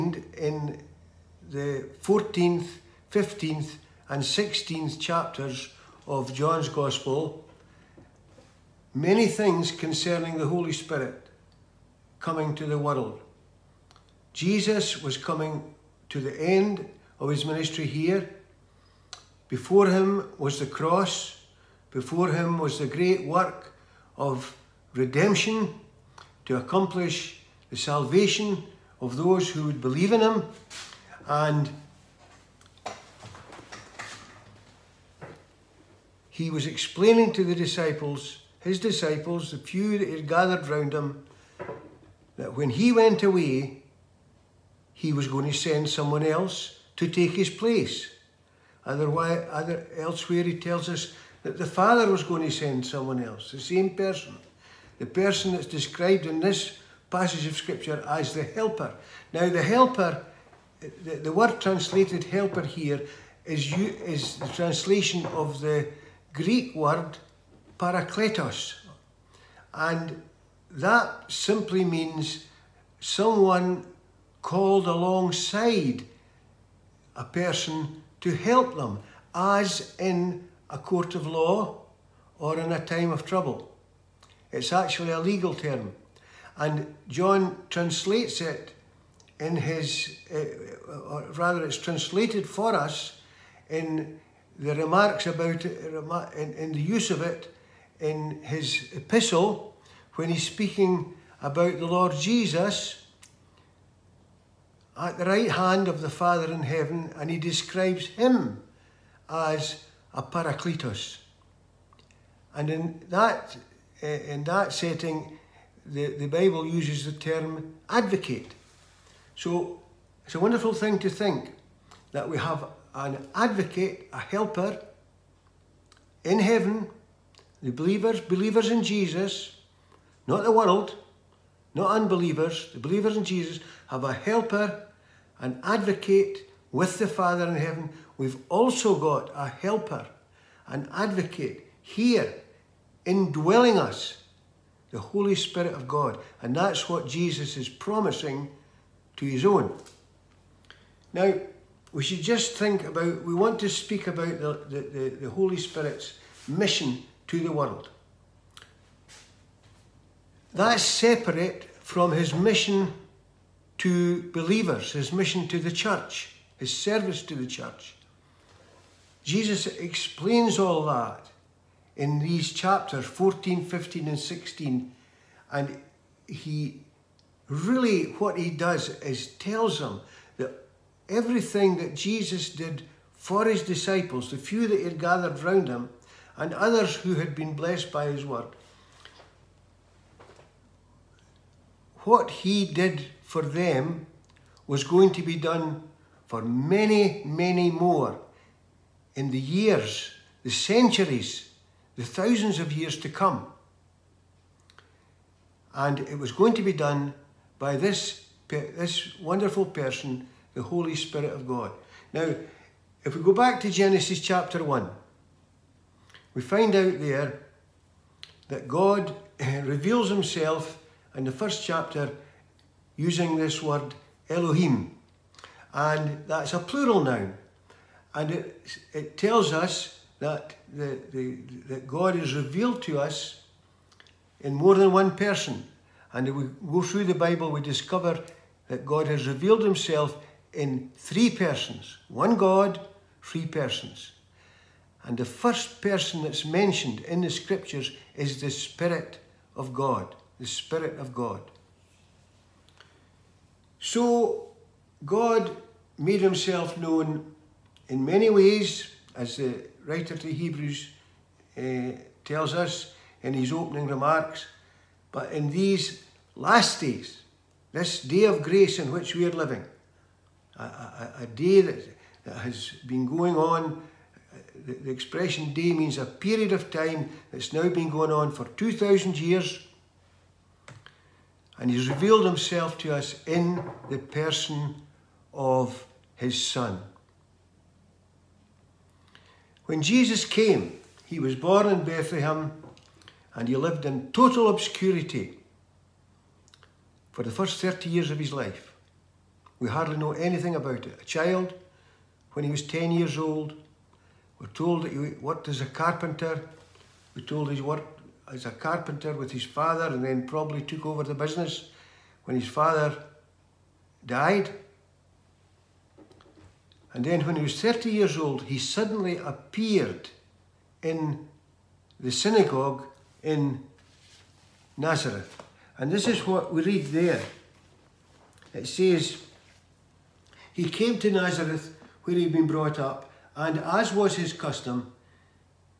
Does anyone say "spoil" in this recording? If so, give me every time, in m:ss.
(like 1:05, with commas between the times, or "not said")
not said.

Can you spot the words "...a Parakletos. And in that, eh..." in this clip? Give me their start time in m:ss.
1:50.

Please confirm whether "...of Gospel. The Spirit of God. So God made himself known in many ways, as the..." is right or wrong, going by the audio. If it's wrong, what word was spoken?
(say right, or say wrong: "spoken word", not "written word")
wrong: "God", not "Gospel".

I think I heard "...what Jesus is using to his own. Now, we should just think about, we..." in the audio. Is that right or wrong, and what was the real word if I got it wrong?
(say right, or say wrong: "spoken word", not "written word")
wrong: "promising", not "using".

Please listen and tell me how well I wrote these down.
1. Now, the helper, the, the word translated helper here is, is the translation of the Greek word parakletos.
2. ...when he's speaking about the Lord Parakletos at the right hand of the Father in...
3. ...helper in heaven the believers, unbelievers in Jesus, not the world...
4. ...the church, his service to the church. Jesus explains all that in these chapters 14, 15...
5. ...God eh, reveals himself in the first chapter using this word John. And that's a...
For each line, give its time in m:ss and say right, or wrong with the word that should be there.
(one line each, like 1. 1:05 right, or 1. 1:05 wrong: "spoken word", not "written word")
1. 0:59 right
2. 1:40 wrong: "Jesus", not "Parakletos"
3. 2:04 wrong: "believers", not "unbelievers"
4. 2:45 right
5. 3:38 wrong: "Elohim", not "John".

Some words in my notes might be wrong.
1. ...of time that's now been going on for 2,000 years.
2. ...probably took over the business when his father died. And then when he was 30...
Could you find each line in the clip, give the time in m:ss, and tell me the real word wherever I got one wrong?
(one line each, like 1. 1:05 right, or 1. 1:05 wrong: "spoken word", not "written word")
1. 4:36 right
2. 5:10 right.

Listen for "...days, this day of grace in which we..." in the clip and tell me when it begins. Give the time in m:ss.
4:26.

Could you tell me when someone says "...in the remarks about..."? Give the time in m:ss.
1:33.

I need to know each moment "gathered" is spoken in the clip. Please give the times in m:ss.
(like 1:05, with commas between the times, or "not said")
0:40, 3:04.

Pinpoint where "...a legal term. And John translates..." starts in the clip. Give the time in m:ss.
1:25.